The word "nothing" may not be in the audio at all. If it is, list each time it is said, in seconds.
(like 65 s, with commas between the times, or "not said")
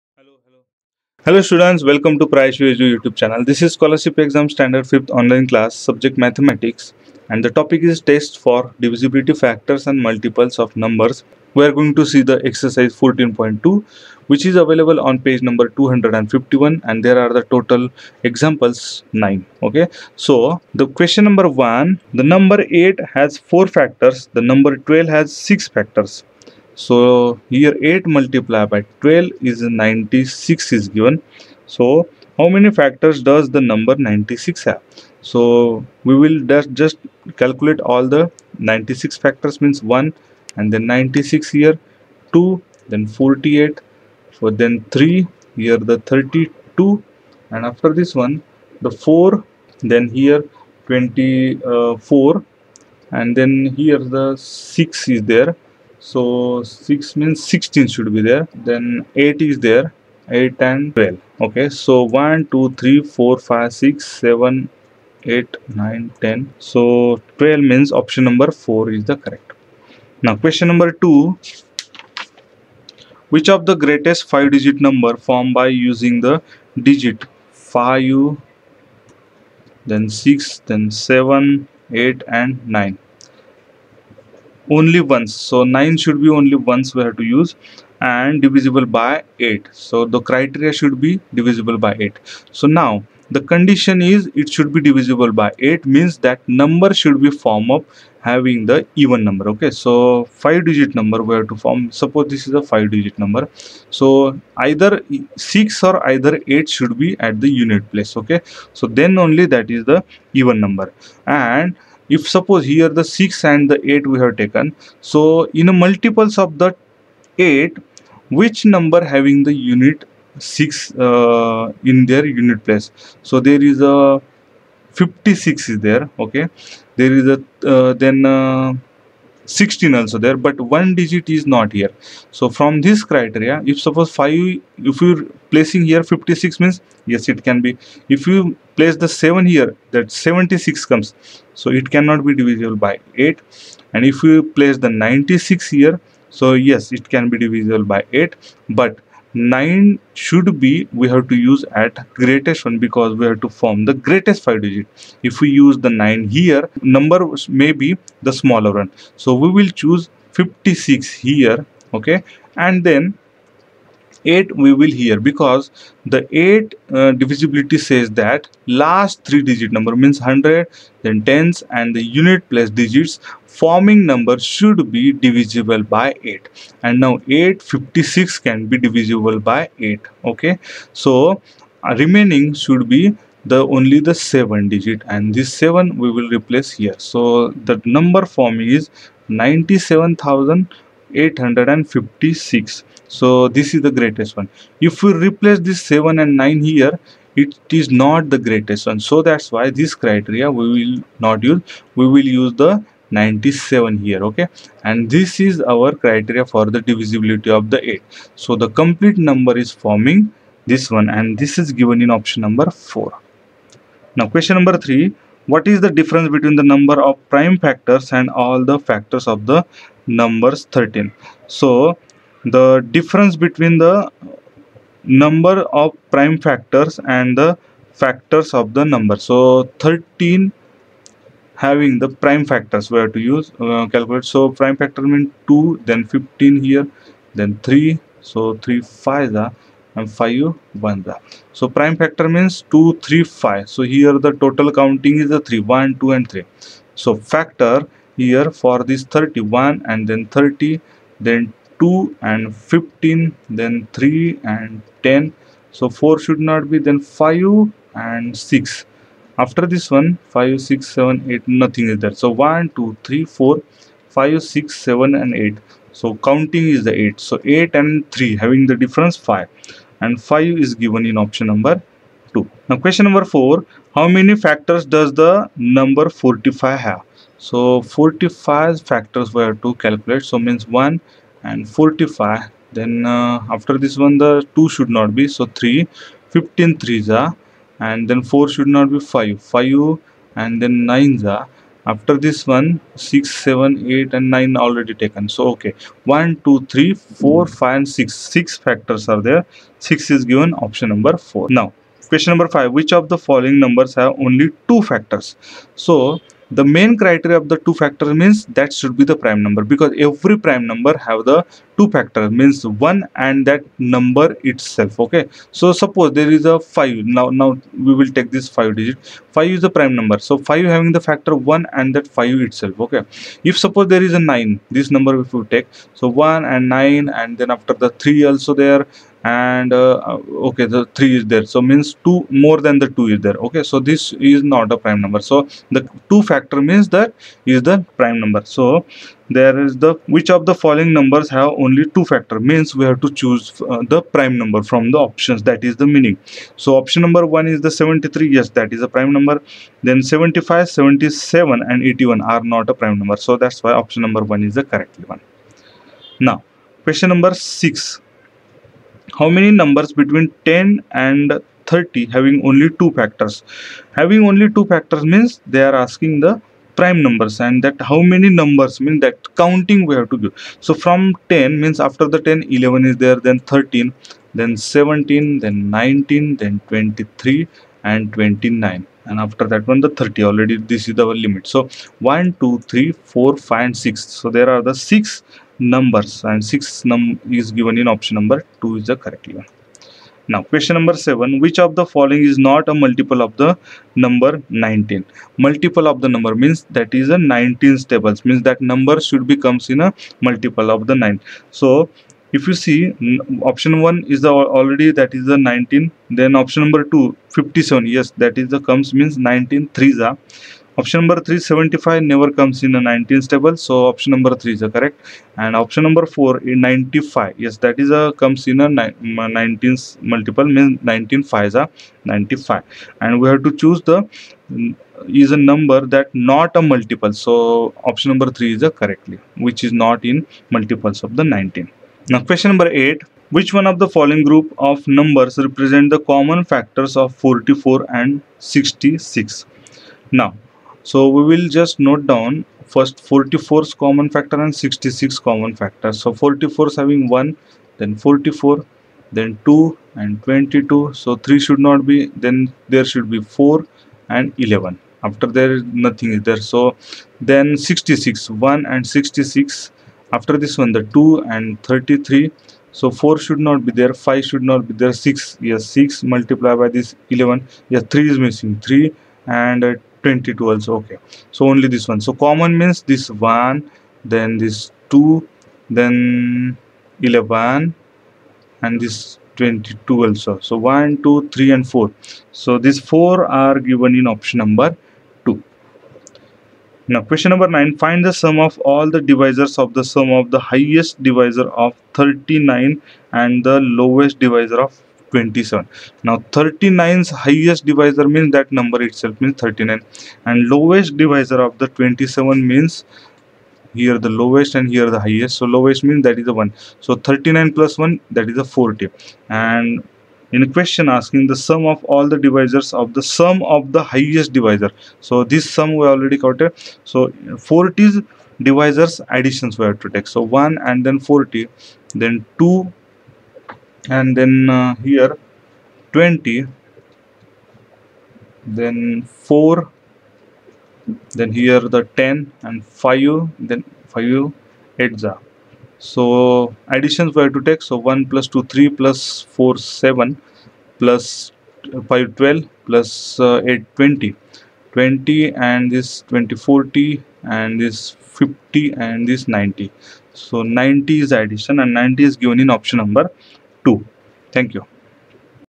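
261 s, 455 s.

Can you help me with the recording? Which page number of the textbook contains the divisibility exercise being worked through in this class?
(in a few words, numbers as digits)
251.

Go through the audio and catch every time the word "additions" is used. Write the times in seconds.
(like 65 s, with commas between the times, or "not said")
519 s, 536 s, 551 s.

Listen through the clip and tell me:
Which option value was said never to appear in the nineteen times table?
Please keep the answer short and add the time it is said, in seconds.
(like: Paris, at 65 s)
375, at 411 s.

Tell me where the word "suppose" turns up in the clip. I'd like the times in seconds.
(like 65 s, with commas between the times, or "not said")
102 s, 112 s, 133 s, 315 s, 323 s.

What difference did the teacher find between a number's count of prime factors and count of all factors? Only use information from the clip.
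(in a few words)
5.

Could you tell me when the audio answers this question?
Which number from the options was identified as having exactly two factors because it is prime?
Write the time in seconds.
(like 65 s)
347 s.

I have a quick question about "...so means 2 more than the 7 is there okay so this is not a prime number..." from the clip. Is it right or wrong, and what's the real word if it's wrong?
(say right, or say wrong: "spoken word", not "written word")
wrong: "2", not "7".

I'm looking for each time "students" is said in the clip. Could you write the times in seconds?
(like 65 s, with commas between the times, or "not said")
1 s.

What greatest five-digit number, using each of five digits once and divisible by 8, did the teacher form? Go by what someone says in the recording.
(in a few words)
97,856.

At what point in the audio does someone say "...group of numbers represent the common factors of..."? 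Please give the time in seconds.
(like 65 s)
434 s.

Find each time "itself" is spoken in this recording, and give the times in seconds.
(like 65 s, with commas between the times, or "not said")
314 s, 322 s, 498 s.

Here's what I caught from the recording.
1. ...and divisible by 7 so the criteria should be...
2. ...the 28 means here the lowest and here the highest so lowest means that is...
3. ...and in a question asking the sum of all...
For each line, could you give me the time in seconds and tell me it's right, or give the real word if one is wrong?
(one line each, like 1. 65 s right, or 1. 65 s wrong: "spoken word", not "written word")
1. 88 s wrong: "8", not "7"
2. 501 s wrong: "27", not "28"
3. 509 s right.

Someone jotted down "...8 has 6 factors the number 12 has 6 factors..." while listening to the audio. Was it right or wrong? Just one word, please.
wrong.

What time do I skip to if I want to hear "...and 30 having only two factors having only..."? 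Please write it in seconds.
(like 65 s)
360 s.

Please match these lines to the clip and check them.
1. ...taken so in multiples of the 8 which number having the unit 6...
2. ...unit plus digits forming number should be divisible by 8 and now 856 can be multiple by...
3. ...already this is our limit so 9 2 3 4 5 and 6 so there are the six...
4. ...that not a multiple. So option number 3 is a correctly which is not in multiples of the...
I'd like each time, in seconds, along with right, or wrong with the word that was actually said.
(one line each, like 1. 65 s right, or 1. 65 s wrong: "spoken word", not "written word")
1. 114 s right
2. 172 s wrong: "divisible", not "multiple"
3. 380 s wrong: "1", not "9"
4. 425 s right.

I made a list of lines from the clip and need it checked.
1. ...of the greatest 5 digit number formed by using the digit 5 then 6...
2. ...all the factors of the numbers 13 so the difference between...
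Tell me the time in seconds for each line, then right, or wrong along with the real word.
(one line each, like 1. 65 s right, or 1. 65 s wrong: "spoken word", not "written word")
1. 73 s right
2. 218 s right.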